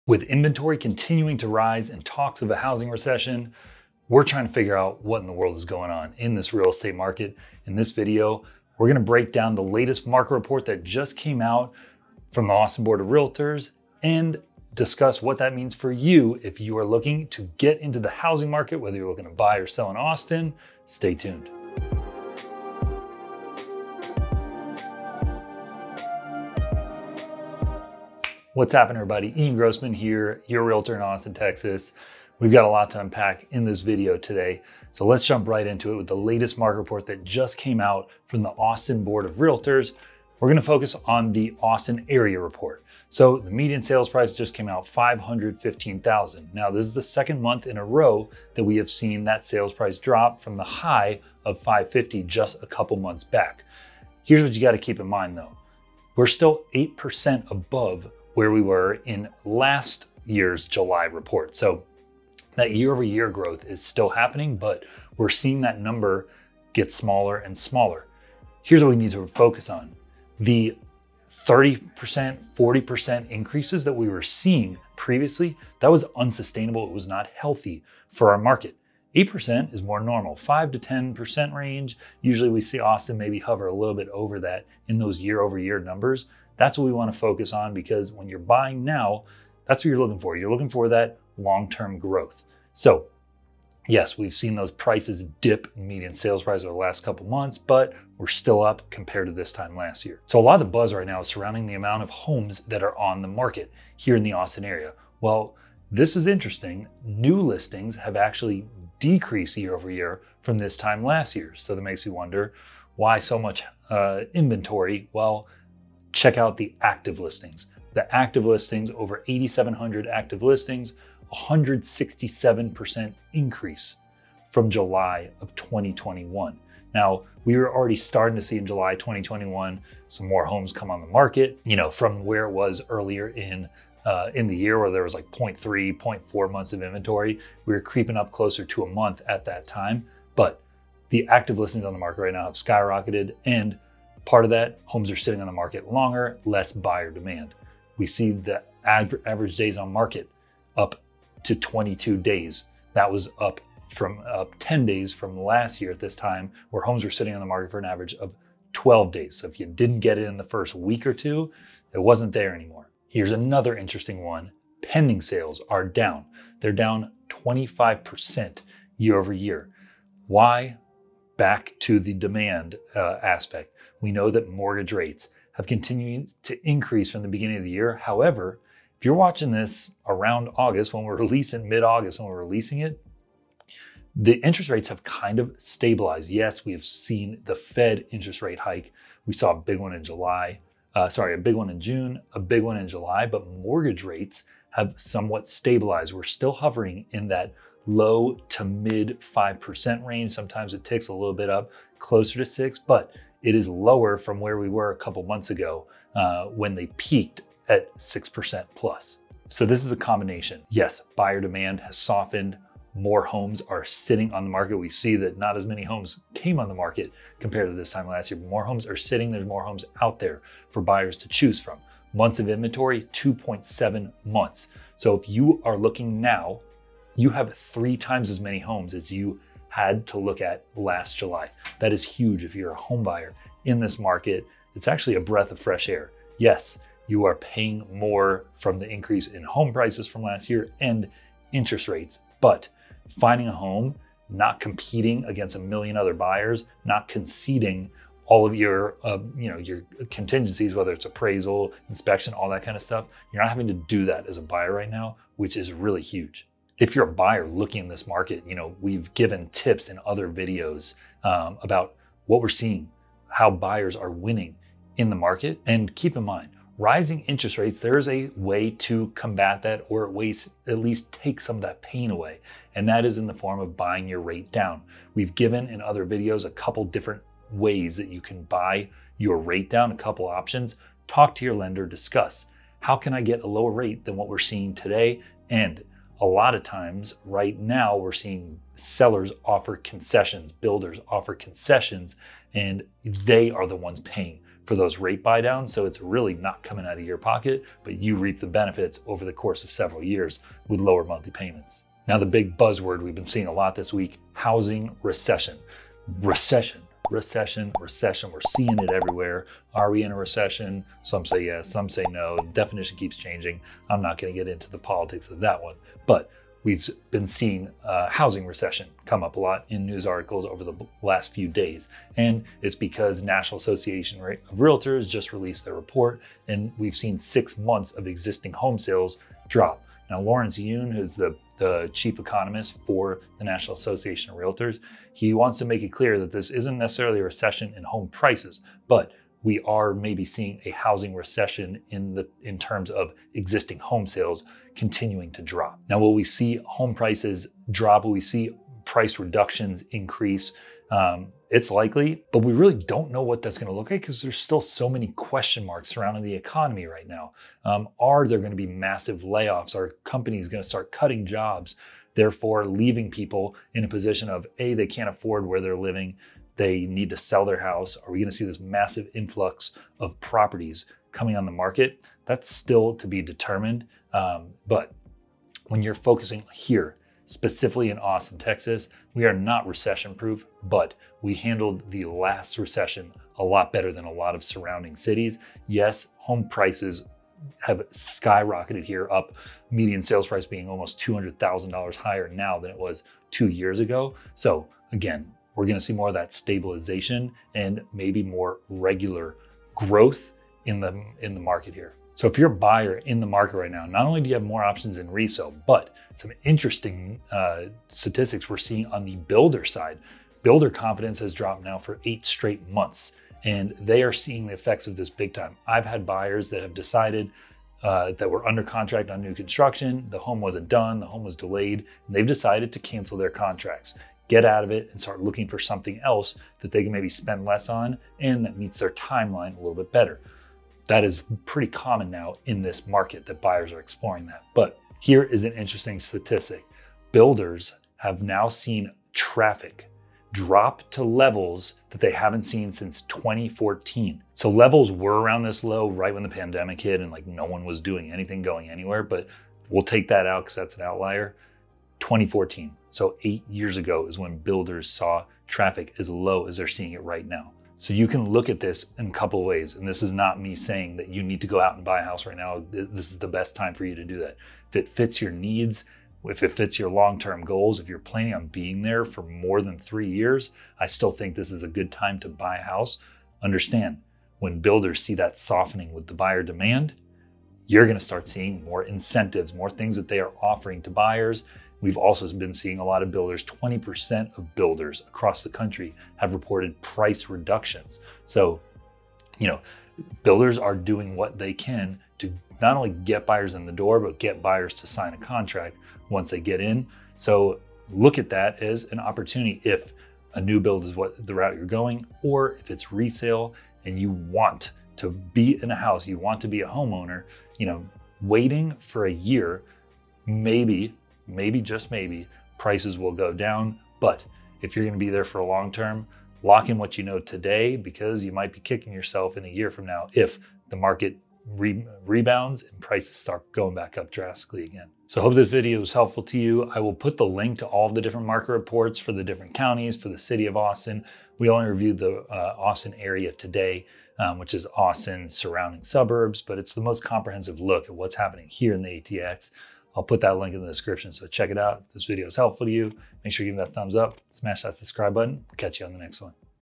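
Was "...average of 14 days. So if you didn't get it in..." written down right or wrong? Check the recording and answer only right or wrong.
wrong.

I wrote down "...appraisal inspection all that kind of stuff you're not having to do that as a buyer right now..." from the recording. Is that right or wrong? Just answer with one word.
right.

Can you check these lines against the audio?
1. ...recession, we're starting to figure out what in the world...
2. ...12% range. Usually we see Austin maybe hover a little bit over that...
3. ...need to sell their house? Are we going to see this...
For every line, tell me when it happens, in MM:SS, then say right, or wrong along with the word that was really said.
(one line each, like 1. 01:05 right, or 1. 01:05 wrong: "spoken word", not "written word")
1. 00:02 wrong: "trying", not "starting"
2. 01:20 wrong: "10", not "12"
3. 06:06 right.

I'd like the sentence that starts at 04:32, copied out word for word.
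And that is in the form of buying your rate down.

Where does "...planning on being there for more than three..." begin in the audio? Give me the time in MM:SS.
07:47.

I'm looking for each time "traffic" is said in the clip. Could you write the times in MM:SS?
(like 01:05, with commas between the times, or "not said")
07:19, 07:35.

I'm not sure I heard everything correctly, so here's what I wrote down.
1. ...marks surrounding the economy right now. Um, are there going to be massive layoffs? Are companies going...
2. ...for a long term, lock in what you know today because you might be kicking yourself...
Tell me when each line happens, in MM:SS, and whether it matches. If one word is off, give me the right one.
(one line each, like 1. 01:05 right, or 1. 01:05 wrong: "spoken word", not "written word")
1. 05:55 right
2. 08:35 right.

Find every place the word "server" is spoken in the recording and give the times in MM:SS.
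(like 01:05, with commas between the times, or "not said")
not said.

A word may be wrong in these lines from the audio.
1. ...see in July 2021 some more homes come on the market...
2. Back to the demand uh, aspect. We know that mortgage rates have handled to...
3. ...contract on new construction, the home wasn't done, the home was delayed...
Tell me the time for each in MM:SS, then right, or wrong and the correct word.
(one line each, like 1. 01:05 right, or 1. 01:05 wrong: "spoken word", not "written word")
1. 02:08 right
2. 02:51 wrong: "continued", not "handled"
3. 06:58 right.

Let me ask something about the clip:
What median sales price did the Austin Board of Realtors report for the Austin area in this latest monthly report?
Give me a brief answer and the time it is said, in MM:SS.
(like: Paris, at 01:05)
515,000, at 00:44.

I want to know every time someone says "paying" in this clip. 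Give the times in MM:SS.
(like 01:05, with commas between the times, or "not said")
03:57, 04:54.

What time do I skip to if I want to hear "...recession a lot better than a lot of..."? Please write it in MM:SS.
06:22.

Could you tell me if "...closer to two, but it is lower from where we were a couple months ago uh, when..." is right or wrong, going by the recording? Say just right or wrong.
wrong.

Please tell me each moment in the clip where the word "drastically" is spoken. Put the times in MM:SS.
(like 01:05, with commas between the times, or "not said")
08:44.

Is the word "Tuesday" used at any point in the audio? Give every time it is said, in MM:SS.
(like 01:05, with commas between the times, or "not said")
not said.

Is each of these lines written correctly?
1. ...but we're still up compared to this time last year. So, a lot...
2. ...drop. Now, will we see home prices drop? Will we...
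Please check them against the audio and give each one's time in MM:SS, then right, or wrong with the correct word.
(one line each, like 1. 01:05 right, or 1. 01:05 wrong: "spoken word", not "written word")
1. 01:37 right
2. 05:45 right.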